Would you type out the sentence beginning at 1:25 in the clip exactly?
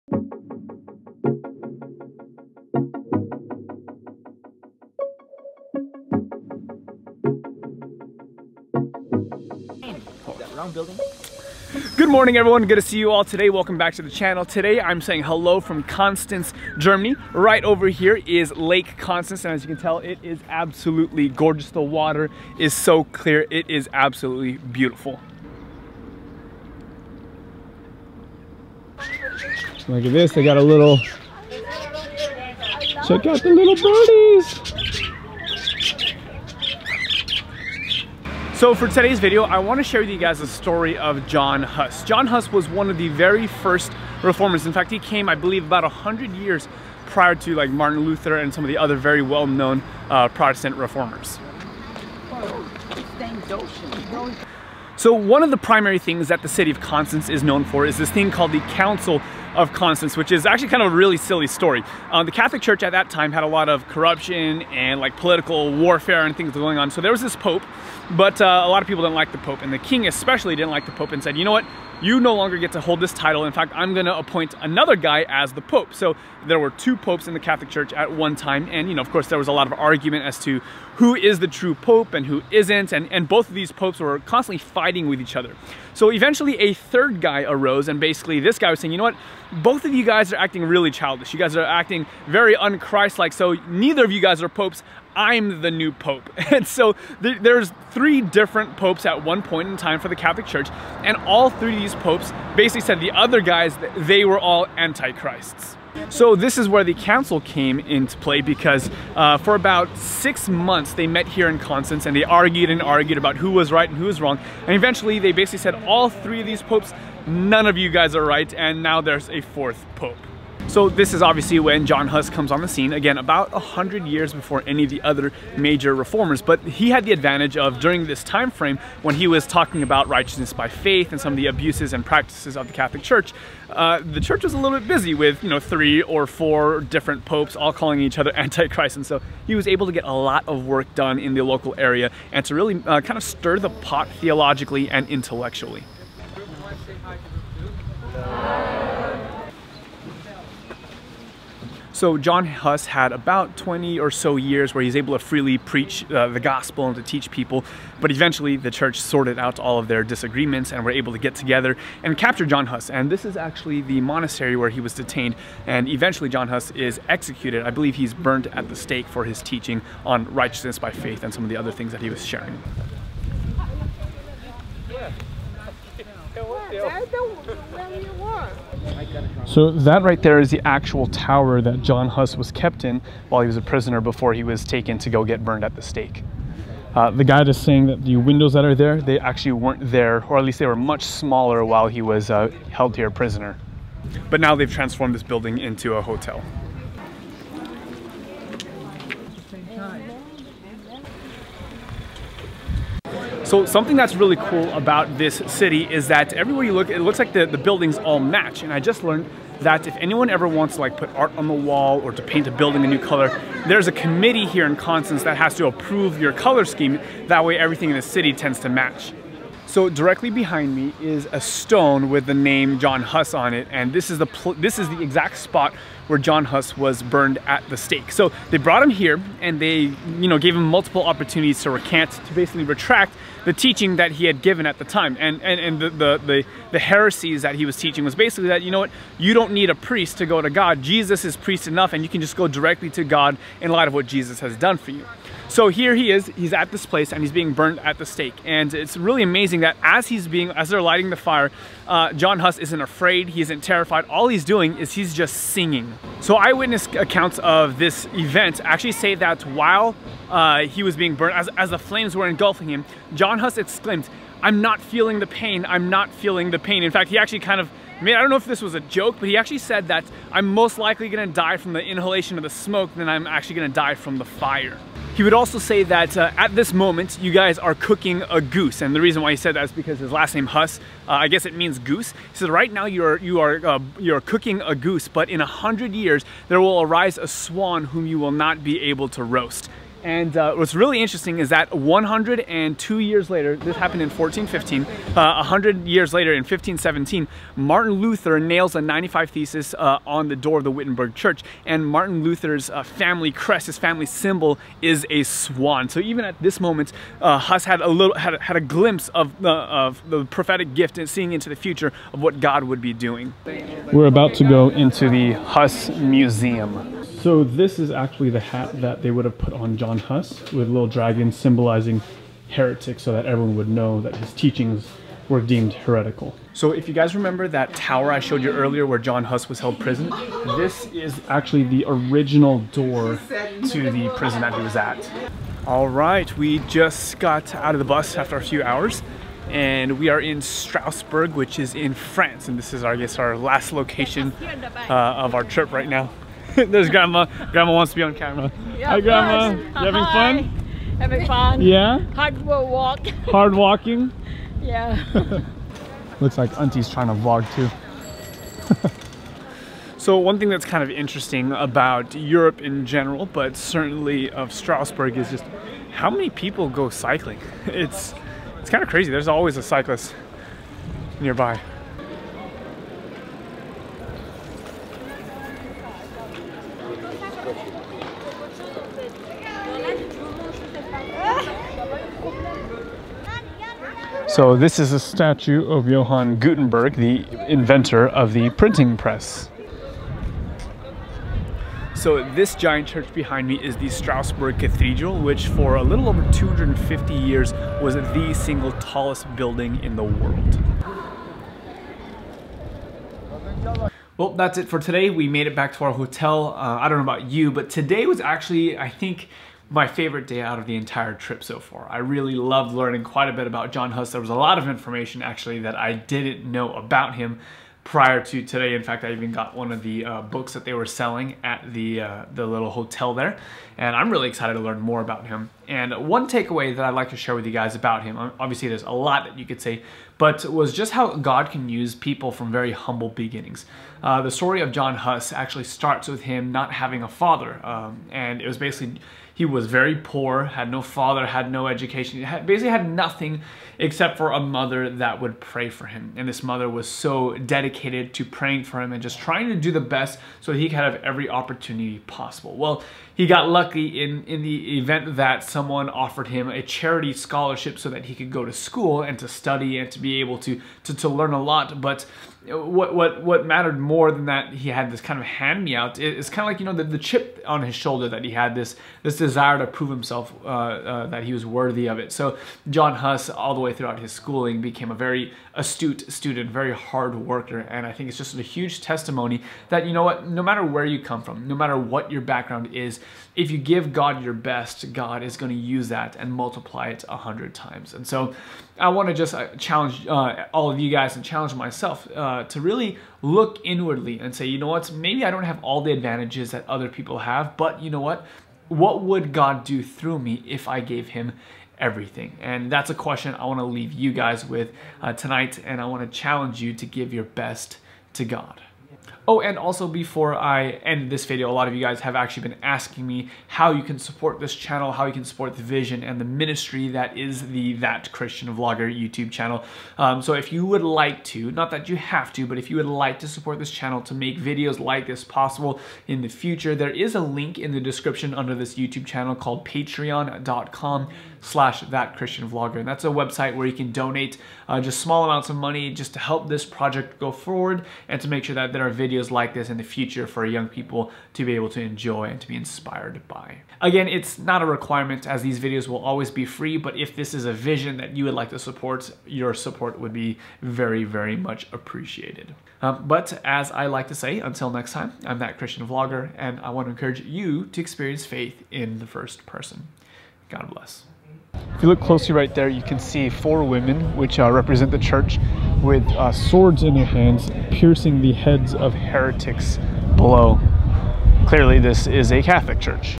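So eventually, a third guy arose, and basically, this guy was saying, you know what?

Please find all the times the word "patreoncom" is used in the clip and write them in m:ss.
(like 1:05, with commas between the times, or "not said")
8:49.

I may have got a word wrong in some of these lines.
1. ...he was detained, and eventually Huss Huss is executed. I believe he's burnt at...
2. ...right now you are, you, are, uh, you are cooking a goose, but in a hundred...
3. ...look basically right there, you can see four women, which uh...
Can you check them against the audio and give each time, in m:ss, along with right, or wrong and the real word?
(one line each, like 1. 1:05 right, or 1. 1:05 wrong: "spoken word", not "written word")
1. 2:44 wrong: "John", not "Huss"
2. 4:42 right
3. 9:21 wrong: "closely", not "basically".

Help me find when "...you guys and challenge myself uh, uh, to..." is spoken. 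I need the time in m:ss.
8:10.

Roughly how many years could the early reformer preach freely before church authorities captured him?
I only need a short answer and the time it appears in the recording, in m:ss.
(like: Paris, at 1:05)
20, at 2:33.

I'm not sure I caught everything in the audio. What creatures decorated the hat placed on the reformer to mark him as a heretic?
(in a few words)
Dragons.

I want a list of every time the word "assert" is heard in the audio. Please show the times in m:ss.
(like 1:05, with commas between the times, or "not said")
not said.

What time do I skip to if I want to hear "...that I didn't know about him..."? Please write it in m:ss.
6:55.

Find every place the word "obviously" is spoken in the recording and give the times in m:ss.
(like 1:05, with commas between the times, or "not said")
2:01, 7:08.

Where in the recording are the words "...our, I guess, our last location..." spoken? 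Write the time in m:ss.
5:42.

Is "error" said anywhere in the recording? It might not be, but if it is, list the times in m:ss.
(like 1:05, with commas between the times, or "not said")
not said.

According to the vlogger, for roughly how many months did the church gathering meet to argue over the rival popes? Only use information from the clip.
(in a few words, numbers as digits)
6 months.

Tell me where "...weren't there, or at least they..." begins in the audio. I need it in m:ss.
3:09.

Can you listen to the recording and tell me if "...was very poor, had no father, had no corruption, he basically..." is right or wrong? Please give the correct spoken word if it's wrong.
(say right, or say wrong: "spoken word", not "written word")
wrong: "education", not "corruption".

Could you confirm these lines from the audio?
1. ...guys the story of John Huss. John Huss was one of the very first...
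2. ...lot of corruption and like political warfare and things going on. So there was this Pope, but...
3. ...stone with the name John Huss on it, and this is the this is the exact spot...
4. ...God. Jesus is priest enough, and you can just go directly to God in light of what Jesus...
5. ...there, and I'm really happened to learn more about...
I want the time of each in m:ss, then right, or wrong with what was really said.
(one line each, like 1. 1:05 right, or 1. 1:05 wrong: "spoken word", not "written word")
1. 0:40 right
2. 1:03 right
3. 3:41 right
4. 4:00 right
5. 7:03 wrong: "excited", not "happened".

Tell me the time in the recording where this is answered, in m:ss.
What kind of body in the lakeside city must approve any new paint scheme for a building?
3:33.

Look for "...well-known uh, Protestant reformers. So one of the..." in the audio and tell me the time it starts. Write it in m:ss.
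0:49.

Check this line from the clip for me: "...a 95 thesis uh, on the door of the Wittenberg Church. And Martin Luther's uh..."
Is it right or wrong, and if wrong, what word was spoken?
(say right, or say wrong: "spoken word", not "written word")
right.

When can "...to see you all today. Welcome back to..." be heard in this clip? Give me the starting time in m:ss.
0:12.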